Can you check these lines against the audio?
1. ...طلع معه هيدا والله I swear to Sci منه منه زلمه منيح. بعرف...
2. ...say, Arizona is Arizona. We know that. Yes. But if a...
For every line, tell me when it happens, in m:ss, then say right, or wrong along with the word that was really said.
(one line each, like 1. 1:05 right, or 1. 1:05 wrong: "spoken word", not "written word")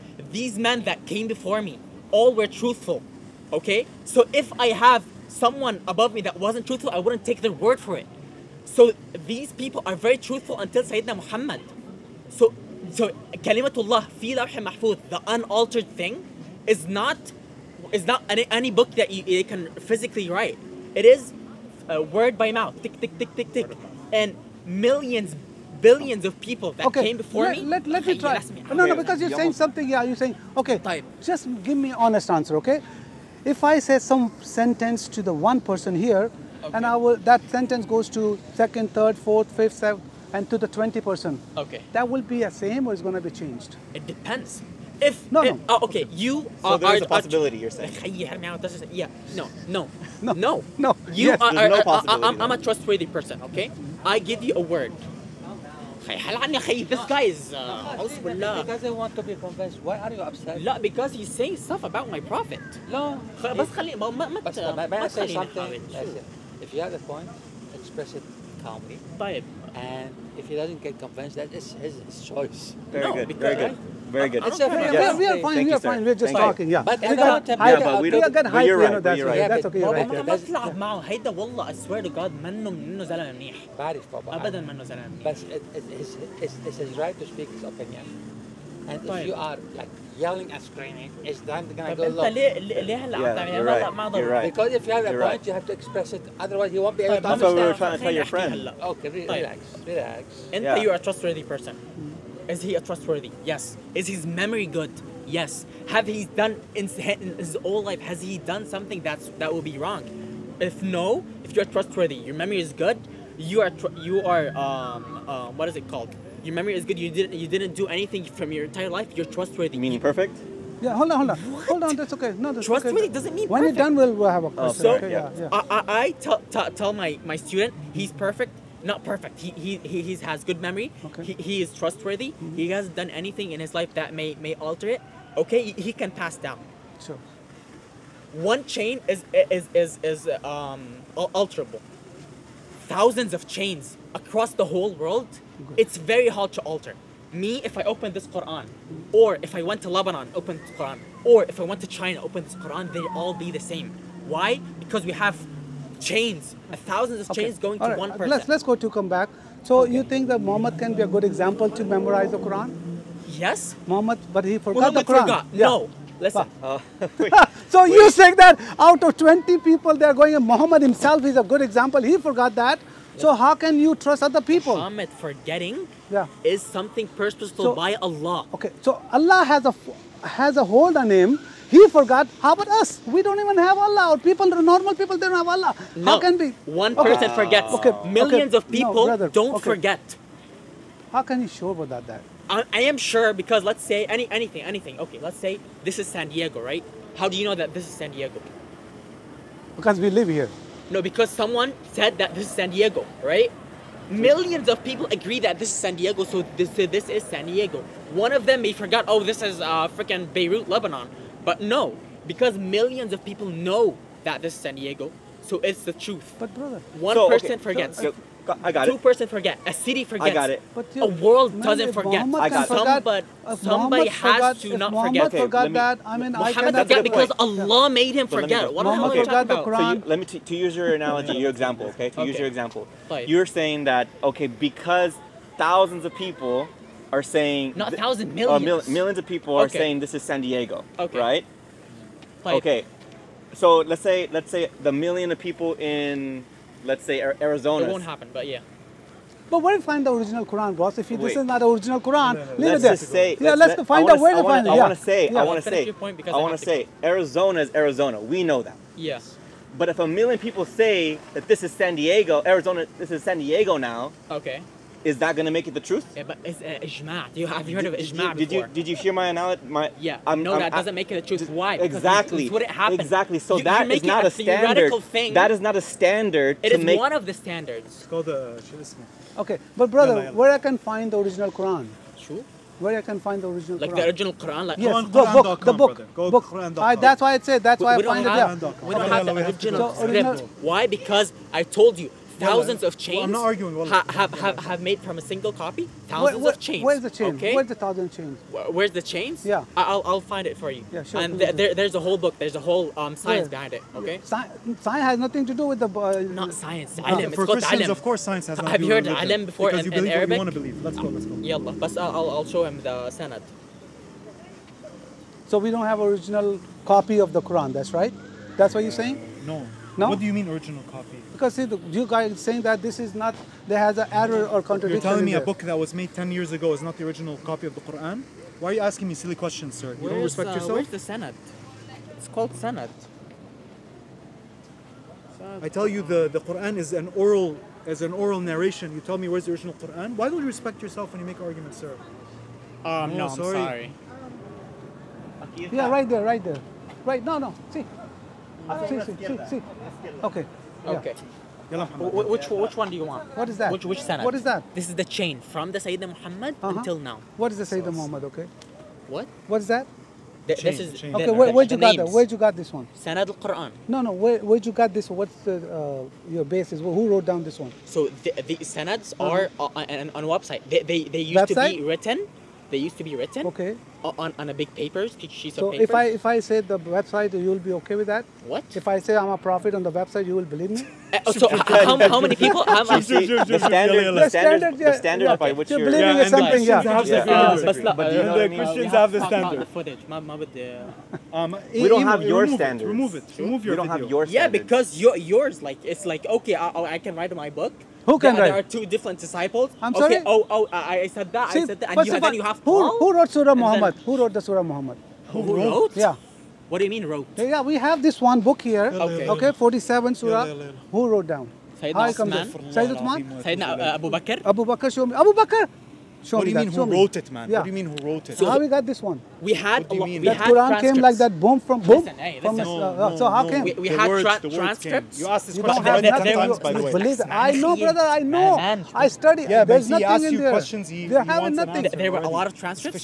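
1. 1:20 wrong: "God", not "Sci"
2. 4:16 right.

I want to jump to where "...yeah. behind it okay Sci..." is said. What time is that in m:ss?
5:03.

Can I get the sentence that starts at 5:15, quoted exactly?
so we don't have original copy of the Quran that's right that's what you're saying no no?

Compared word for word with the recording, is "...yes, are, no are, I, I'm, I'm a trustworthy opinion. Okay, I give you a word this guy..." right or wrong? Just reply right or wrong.
wrong.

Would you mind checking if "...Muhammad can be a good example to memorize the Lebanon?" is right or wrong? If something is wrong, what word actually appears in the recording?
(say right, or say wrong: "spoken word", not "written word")
wrong: "Quran", not "Lebanon".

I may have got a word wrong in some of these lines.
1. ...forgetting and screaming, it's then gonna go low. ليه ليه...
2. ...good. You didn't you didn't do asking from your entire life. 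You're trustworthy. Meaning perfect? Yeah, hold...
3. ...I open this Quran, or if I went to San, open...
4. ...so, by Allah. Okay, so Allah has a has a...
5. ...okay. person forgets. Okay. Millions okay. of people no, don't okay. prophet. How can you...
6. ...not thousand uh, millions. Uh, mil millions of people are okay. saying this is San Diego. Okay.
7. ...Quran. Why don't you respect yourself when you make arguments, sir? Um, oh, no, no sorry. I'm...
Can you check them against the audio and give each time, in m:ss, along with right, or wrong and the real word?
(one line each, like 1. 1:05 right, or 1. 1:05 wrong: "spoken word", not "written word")
1. 1:30 wrong: "yelling", not "forgetting"
2. 1:56 wrong: "anything", not "asking"
3. 2:27 wrong: "Lebanon", not "San"
4. 2:57 right
5. 3:06 wrong: "forget", not "prophet"
6. 3:57 right
7. 5:39 right.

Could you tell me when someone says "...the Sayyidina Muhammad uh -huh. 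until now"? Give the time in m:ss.
5:55.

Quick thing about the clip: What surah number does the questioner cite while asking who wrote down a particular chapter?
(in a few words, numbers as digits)
47.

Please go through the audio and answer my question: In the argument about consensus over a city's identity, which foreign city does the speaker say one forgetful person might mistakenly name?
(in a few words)
Beirut, Lebanon.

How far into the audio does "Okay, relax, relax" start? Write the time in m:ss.
1:38.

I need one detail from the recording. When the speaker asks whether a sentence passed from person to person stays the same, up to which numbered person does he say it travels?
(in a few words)
20.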